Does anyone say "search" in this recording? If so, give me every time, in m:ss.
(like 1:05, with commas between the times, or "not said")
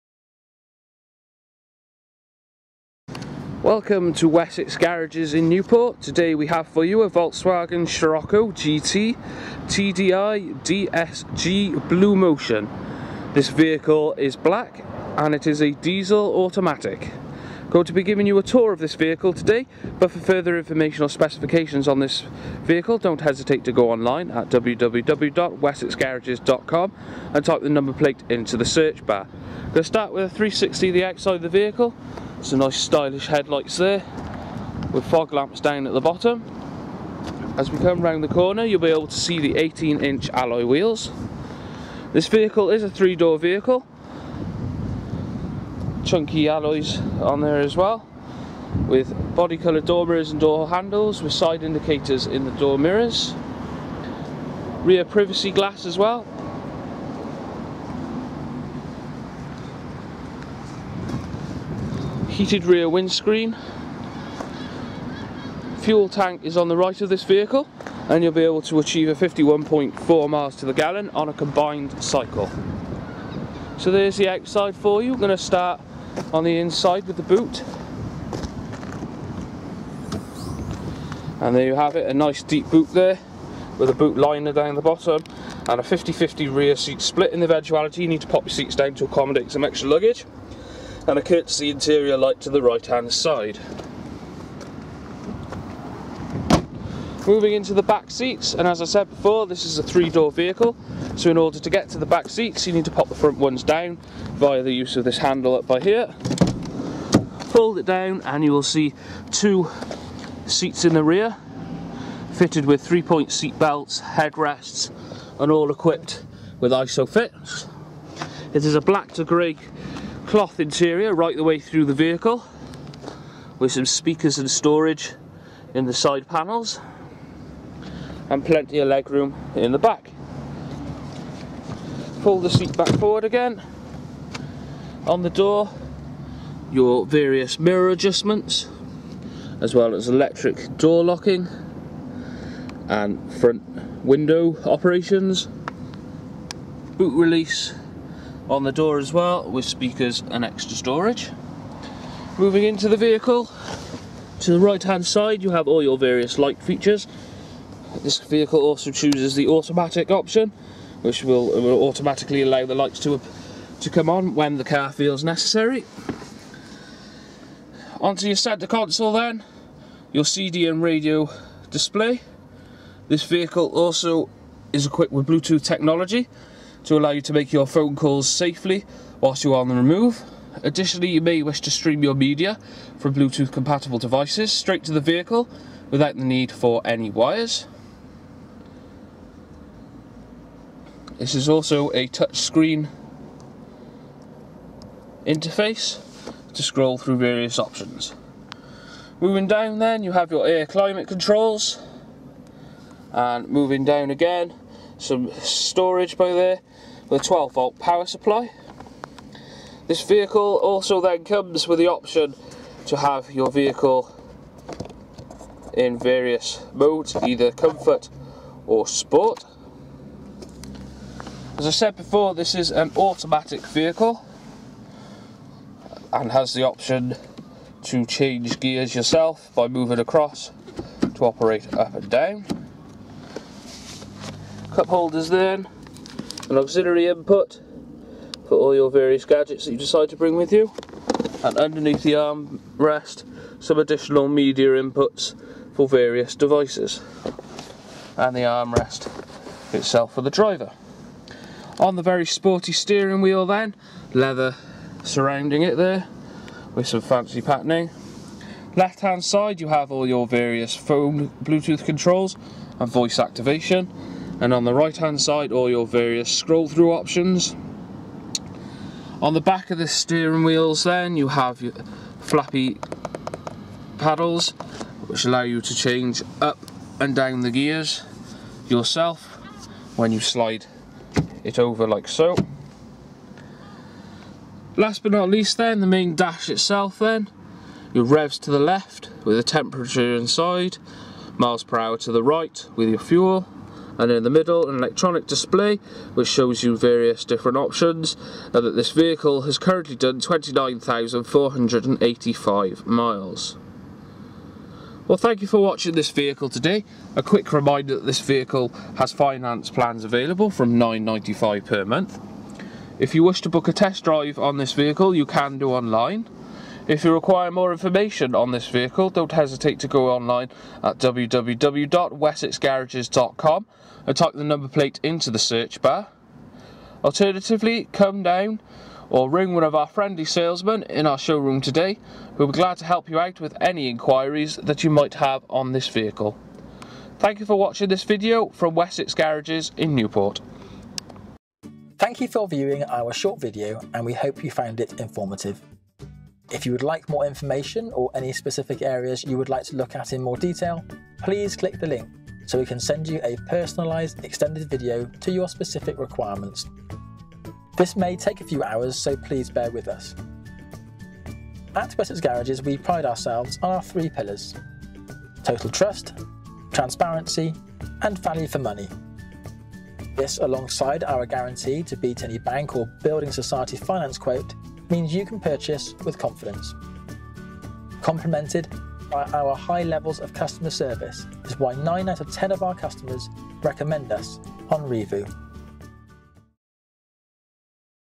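0:28, 5:25.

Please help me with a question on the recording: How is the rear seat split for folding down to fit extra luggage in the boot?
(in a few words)
50-50.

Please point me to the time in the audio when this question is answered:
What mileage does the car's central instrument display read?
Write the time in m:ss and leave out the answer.
5:00.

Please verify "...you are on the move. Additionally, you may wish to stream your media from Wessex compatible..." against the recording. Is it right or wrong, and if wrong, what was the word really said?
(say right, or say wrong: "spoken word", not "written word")
wrong: "Bluetooth", not "Wessex".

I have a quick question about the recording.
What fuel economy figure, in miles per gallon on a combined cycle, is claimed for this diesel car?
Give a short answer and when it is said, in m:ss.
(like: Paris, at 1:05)
51.4, at 1:09.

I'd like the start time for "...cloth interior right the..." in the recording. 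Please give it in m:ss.
2:00.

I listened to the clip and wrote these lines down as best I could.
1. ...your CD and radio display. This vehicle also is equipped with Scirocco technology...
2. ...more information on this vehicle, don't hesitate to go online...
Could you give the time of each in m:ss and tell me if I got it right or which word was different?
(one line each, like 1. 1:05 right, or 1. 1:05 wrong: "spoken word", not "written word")
1. 2:50 wrong: "Bluetooth", not "Scirocco"
2. 5:17 right.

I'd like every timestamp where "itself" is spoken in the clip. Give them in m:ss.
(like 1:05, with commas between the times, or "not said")
4:09, 4:46.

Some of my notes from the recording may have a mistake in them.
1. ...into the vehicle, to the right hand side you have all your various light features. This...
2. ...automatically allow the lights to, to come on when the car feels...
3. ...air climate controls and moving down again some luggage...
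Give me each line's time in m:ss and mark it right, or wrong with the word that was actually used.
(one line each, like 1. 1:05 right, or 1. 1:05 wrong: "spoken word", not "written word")
1. 2:32 right
2. 2:41 right
3. 3:20 wrong: "storage", not "luggage".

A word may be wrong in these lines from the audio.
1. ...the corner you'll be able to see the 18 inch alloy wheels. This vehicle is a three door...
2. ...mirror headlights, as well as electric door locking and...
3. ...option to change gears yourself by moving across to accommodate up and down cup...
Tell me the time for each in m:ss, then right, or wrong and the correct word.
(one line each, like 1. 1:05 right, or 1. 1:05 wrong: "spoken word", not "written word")
1. 0:38 right
2. 2:17 wrong: "adjustments", not "headlights"
3. 3:46 wrong: "operate", not "accommodate".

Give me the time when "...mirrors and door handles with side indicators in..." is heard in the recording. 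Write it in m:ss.
0:50.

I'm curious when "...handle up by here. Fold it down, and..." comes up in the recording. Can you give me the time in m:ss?
1:45.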